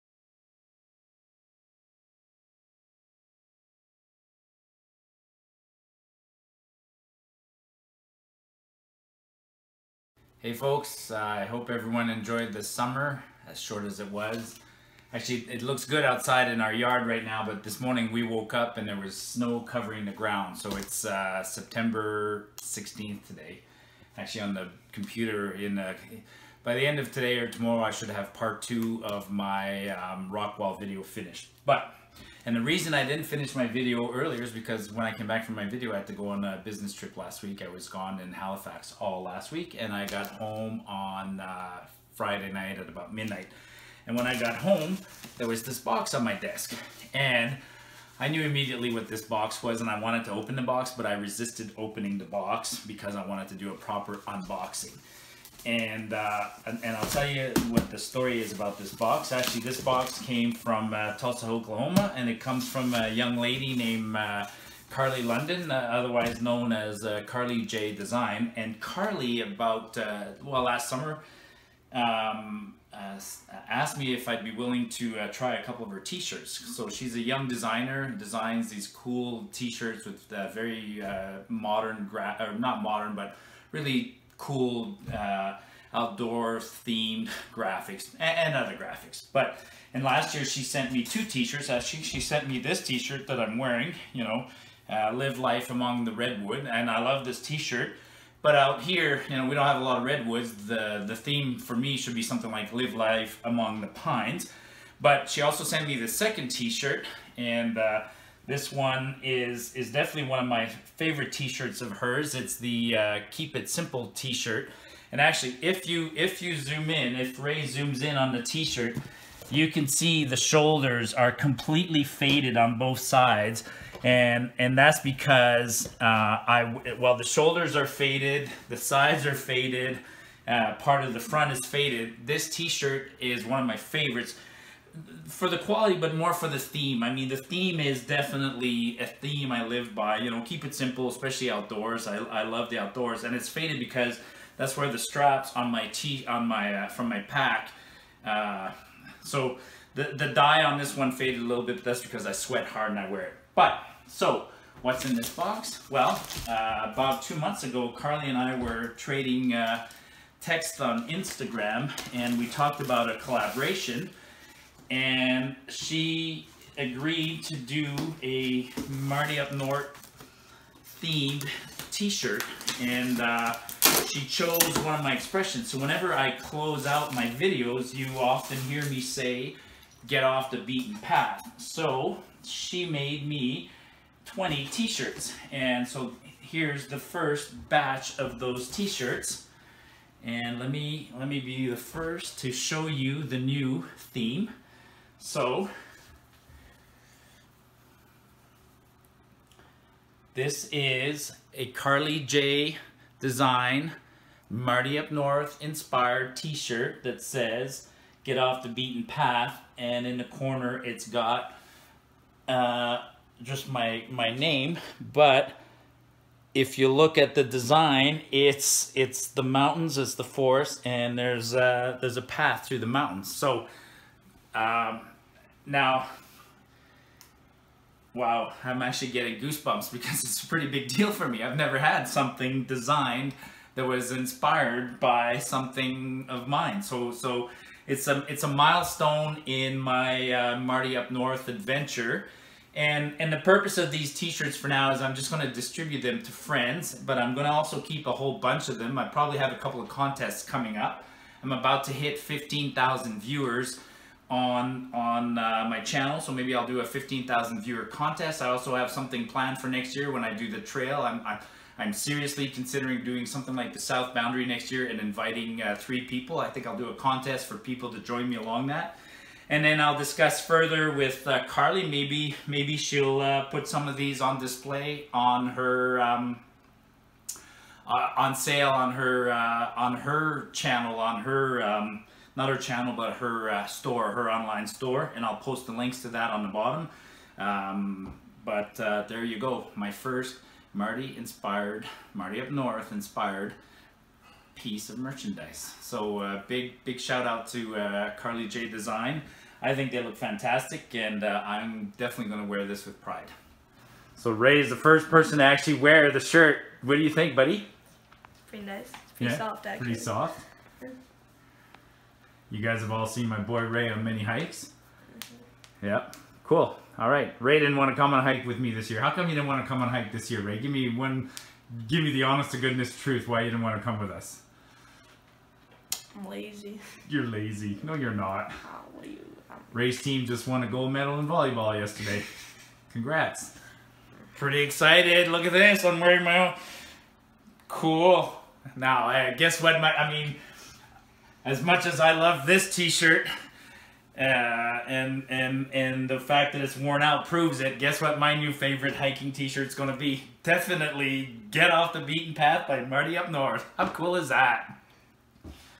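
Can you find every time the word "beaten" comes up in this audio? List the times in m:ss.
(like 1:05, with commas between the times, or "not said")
3:00, 3:28, 5:52.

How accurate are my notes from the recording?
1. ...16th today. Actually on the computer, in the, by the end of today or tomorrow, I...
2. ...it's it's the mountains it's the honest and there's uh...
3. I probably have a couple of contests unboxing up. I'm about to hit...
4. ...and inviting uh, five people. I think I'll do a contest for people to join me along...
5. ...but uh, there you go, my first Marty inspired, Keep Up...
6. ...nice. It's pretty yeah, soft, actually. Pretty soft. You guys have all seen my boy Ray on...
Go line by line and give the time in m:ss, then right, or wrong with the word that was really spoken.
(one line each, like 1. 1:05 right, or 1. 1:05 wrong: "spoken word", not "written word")
1. 0:22 right
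2. 3:38 wrong: "forest", not "honest"
3. 4:08 wrong: "coming", not "unboxing"
4. 4:24 wrong: "three", not "five"
5. 4:48 wrong: "Marty", not "Keep"
6. 5:08 right.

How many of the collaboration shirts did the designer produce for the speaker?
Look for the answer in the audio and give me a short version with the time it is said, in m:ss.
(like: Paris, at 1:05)
20, at 3:04.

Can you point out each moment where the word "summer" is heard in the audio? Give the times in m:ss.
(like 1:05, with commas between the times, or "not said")
0:12, 1:10.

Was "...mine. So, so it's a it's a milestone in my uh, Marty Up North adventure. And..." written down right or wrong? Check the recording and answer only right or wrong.
right.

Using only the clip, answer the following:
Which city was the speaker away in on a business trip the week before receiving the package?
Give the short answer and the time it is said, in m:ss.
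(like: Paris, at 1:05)
Halifax, at 0:38.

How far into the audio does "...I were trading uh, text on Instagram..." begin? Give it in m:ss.
2:38.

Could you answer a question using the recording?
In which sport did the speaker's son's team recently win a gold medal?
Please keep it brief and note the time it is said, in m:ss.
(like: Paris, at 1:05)
Volleyball, at 5:31.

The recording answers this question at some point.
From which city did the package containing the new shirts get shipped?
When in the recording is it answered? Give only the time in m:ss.
1:01.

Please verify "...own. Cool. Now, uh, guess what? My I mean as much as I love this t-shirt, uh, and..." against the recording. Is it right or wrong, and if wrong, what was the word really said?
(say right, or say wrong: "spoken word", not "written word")
right.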